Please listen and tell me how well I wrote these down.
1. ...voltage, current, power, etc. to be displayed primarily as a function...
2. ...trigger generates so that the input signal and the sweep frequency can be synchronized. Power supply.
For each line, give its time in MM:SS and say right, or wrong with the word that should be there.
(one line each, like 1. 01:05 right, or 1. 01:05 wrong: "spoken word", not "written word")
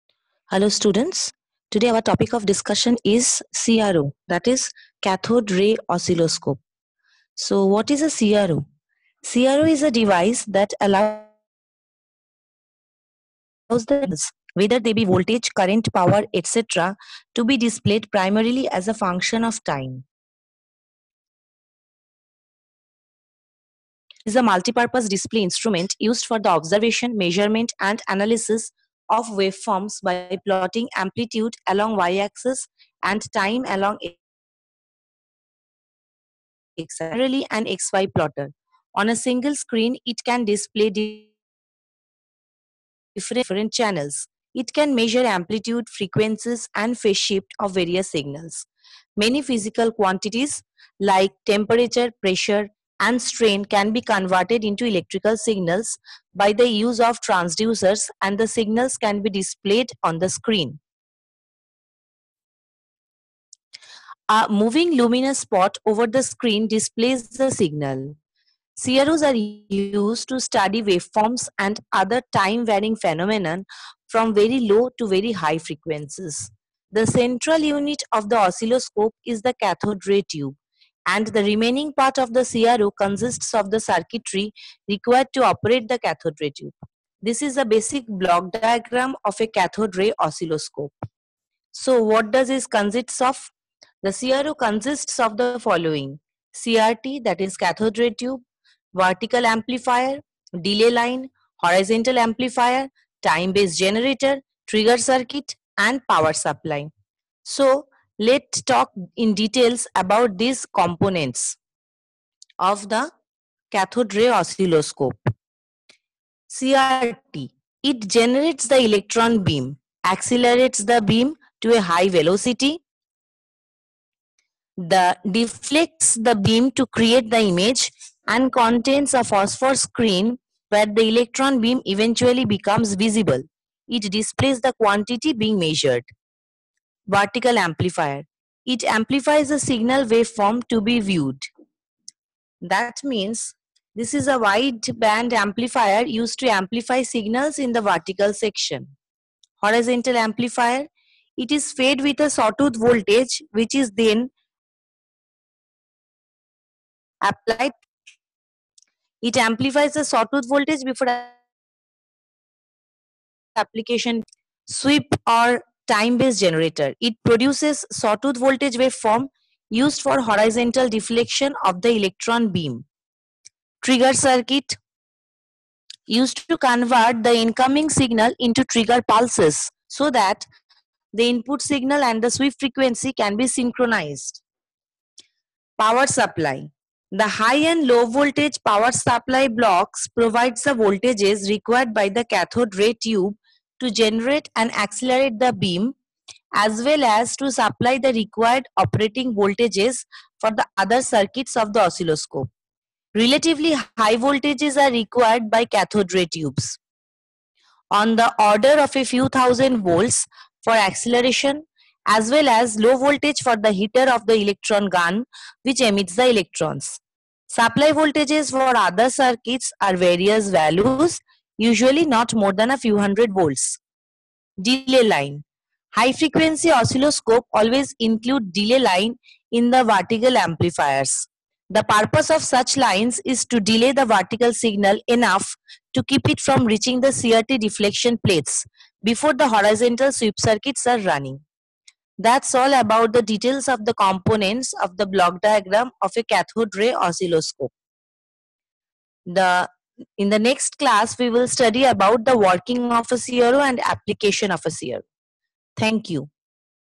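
1. 00:15 right
2. 02:58 wrong: "pulses", not "generates".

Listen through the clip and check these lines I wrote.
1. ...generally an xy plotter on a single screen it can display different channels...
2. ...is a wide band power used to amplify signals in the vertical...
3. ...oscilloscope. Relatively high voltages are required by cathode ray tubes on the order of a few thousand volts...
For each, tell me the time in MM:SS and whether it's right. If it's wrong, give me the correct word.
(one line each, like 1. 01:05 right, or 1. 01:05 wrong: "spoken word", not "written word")
1. 00:36 right
2. 02:24 wrong: "amplifier", not "power"
3. 03:21 right.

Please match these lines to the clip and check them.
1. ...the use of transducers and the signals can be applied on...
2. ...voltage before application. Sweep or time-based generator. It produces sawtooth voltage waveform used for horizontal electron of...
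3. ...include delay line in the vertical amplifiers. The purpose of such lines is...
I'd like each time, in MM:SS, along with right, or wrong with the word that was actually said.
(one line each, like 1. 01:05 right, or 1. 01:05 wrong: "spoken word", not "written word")
1. 00:56 wrong: "displayed", not "applied"
2. 02:40 wrong: "deflection", not "electron"
3. 03:47 right.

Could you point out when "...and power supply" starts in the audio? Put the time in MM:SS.
01:45.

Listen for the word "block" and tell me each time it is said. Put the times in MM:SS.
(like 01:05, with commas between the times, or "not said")
01:28, 03:09, 04:05.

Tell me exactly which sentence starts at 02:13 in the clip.
It displays the quantity being measured vertical amplifier.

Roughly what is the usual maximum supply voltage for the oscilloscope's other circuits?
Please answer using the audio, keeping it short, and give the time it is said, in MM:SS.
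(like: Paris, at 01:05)
A few hundred volts, at 03:42.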